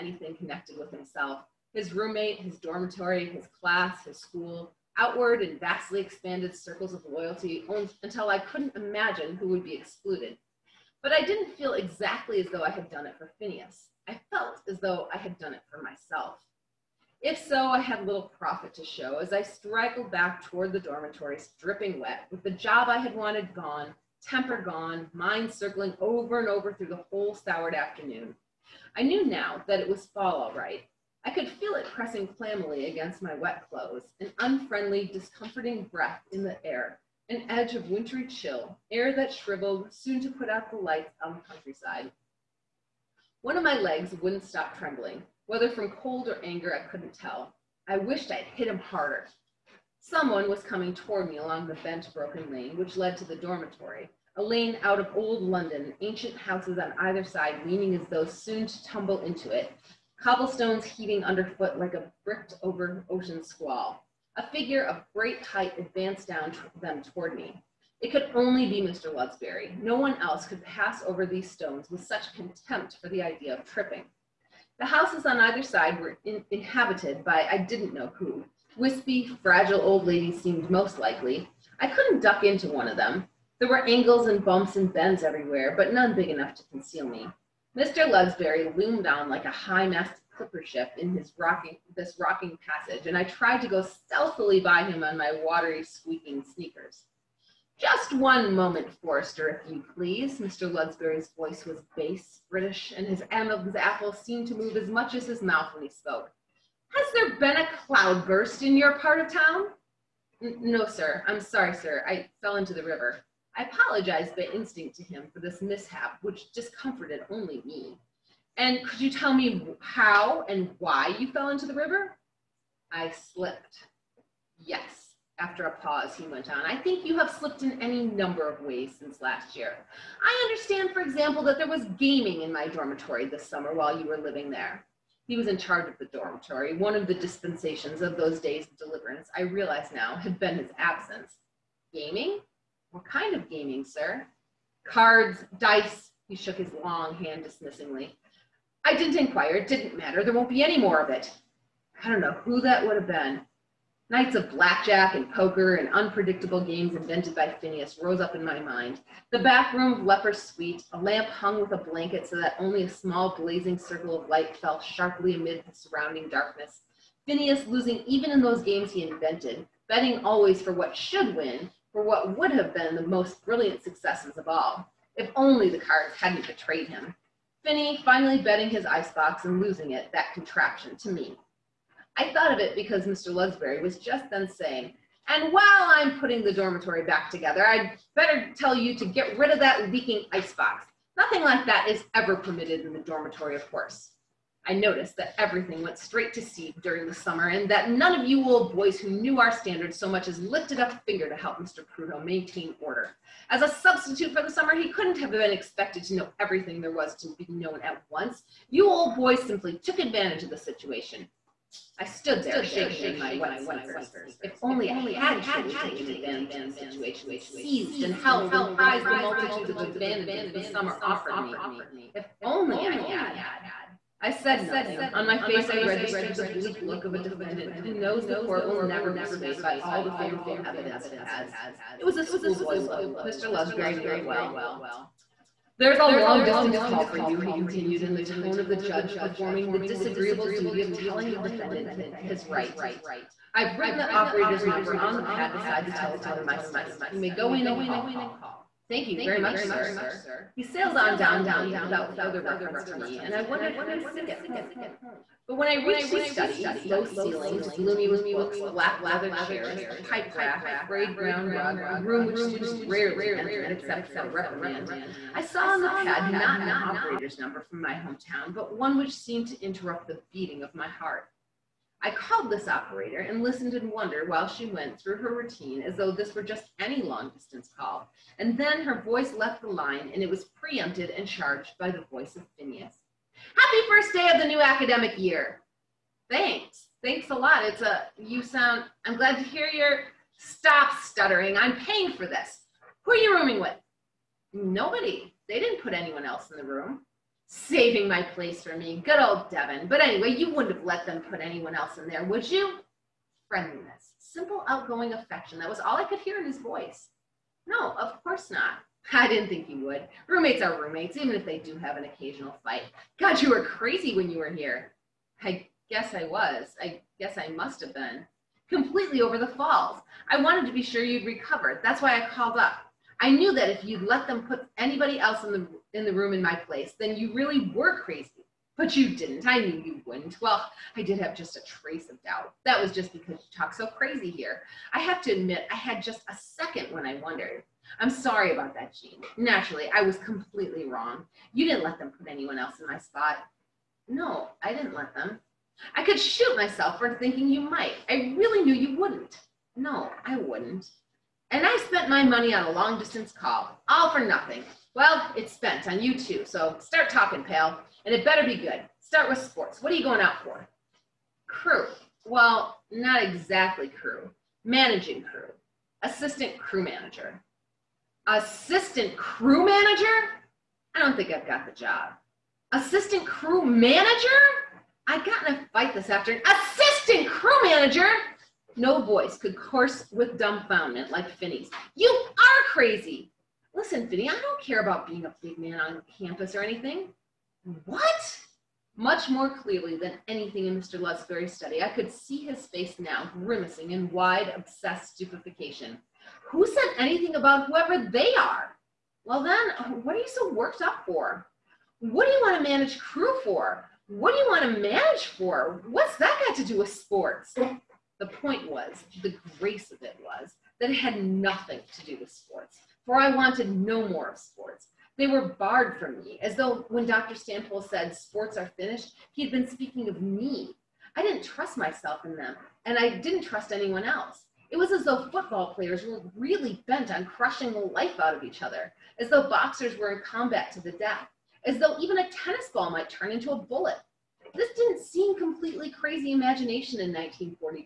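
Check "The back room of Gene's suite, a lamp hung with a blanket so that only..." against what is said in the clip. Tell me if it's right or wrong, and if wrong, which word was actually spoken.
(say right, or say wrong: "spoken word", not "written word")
wrong: "Leper", not "Gene".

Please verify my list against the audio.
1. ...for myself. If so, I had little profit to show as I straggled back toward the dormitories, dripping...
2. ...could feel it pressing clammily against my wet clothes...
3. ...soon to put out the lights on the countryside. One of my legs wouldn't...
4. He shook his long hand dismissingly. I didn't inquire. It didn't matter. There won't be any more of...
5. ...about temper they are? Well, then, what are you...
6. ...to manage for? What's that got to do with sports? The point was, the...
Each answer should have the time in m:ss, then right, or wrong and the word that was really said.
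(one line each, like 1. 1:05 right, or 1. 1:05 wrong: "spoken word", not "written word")
1. 0:15 right
2. 0:31 right
3. 0:39 right
4. 2:26 right
5. 6:37 wrong: "whoever", not "temper"
6. 6:44 right.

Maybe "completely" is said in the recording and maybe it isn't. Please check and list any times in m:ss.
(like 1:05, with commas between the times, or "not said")
5:18, 5:40, 7:15.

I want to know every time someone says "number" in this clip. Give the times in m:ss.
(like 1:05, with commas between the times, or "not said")
2:08, 4:04, 4:27.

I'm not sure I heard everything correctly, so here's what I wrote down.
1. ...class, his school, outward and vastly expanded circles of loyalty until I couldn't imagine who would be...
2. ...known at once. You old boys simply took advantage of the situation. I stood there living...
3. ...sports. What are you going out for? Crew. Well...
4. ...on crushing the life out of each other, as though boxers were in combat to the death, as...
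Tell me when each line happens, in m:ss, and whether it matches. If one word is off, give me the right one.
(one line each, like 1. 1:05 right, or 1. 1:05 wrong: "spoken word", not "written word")
1. 0:03 right
2. 3:27 wrong: "shaking", not "living"
3. 5:59 right
4. 7:07 right.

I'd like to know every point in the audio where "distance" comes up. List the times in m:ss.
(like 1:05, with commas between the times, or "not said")
3:56, 4:37, 5:52.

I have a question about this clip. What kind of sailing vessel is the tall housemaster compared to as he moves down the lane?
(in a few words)
high-masted clipper ship.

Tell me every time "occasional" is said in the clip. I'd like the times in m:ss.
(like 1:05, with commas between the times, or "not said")
5:12.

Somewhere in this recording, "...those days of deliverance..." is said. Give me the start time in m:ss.
2:18.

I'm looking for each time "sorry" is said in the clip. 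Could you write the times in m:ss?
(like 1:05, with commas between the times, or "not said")
1:51, 5:38.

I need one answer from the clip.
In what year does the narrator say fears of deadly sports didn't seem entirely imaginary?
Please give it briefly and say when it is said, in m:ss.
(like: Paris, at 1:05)
1942, at 7:17.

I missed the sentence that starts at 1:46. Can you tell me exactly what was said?
Has there been a cloudburst in your part of town?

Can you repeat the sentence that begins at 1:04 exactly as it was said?
A figure of great height advanced down them toward me.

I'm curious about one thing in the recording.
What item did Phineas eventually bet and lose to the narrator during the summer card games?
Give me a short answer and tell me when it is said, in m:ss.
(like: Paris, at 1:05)
his icebox, at 2:58.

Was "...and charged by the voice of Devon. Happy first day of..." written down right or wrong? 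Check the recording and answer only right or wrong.
wrong.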